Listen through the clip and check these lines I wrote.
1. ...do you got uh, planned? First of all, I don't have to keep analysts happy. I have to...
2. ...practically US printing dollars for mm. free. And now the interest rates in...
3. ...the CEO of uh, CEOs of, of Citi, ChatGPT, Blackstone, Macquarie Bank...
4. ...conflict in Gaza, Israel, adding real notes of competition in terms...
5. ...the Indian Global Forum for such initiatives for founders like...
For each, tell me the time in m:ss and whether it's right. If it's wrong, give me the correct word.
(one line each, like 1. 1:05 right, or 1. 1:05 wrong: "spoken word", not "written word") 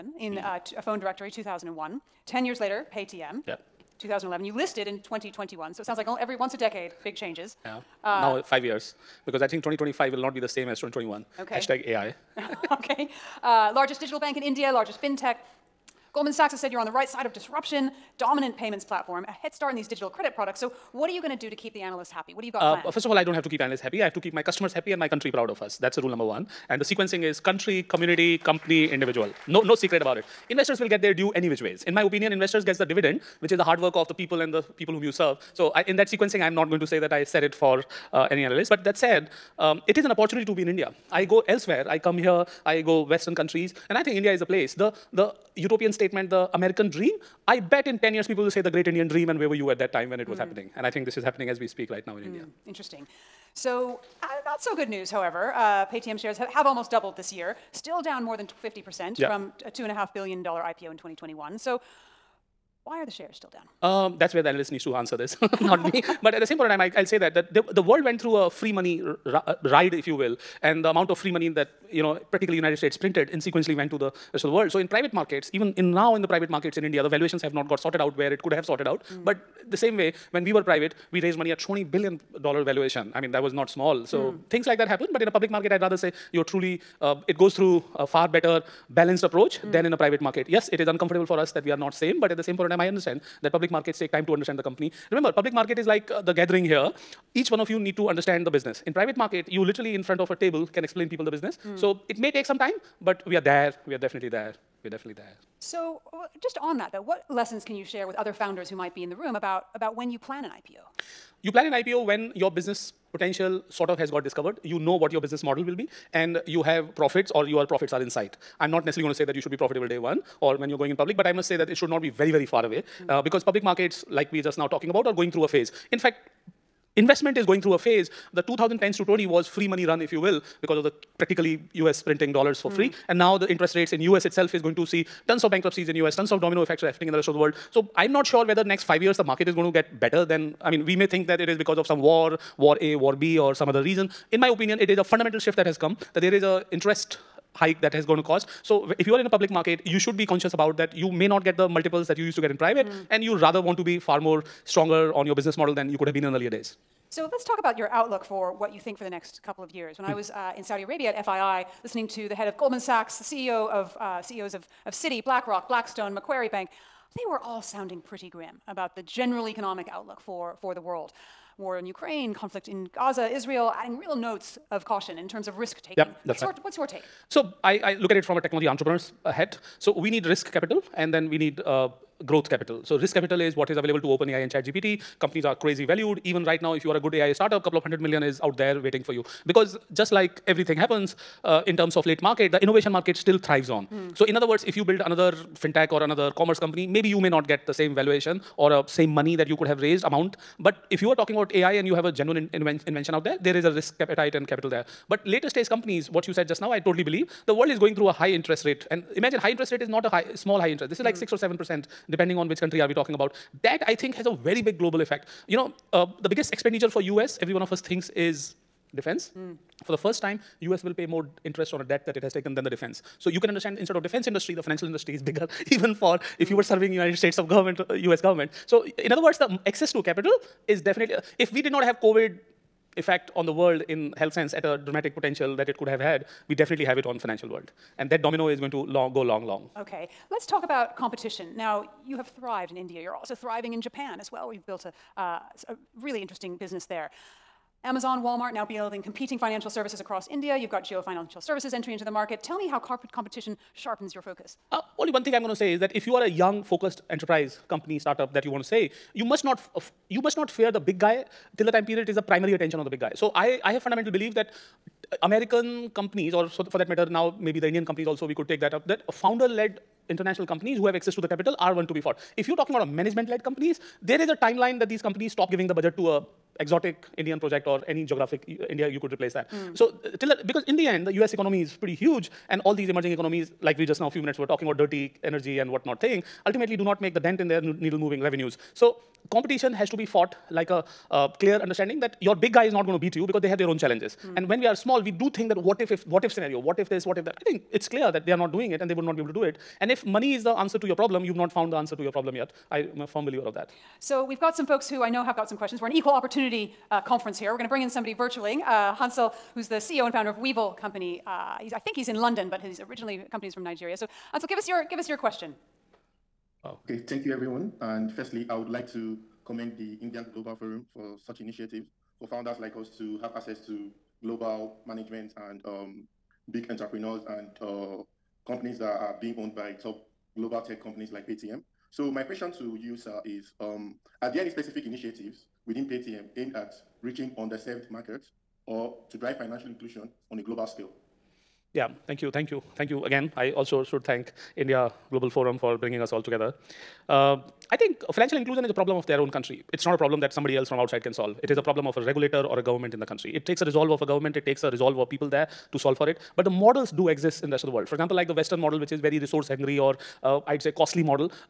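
1. 0:22 right
2. 2:11 right
3. 2:43 wrong: "BlackRock", not "ChatGPT"
4. 2:52 wrong: "caution", not "competition"
5. 5:19 right.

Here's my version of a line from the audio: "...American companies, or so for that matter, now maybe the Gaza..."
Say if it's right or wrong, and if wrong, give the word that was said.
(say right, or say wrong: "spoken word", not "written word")
wrong: "Indian", not "Gaza".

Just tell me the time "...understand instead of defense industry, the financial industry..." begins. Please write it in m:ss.
3:43.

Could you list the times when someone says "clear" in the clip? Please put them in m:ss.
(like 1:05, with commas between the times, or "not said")
4:51, 4:57.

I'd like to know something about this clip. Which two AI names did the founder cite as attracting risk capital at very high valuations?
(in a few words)
OpenAI and ChatGPT.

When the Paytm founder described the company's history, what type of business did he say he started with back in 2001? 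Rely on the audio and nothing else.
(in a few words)
phone directory.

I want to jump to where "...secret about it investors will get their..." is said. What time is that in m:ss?
0:29.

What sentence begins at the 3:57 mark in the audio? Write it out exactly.
And that domino is going to long, go long, long.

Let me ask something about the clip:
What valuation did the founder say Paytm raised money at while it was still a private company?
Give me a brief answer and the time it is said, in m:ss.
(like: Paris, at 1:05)
20 billion dollars, at 1:21.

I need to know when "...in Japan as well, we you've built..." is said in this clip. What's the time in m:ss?
4:03.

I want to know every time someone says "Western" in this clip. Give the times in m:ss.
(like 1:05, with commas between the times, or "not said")
0:43, 5:58.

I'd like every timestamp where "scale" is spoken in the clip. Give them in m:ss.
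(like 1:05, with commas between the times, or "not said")
5:40.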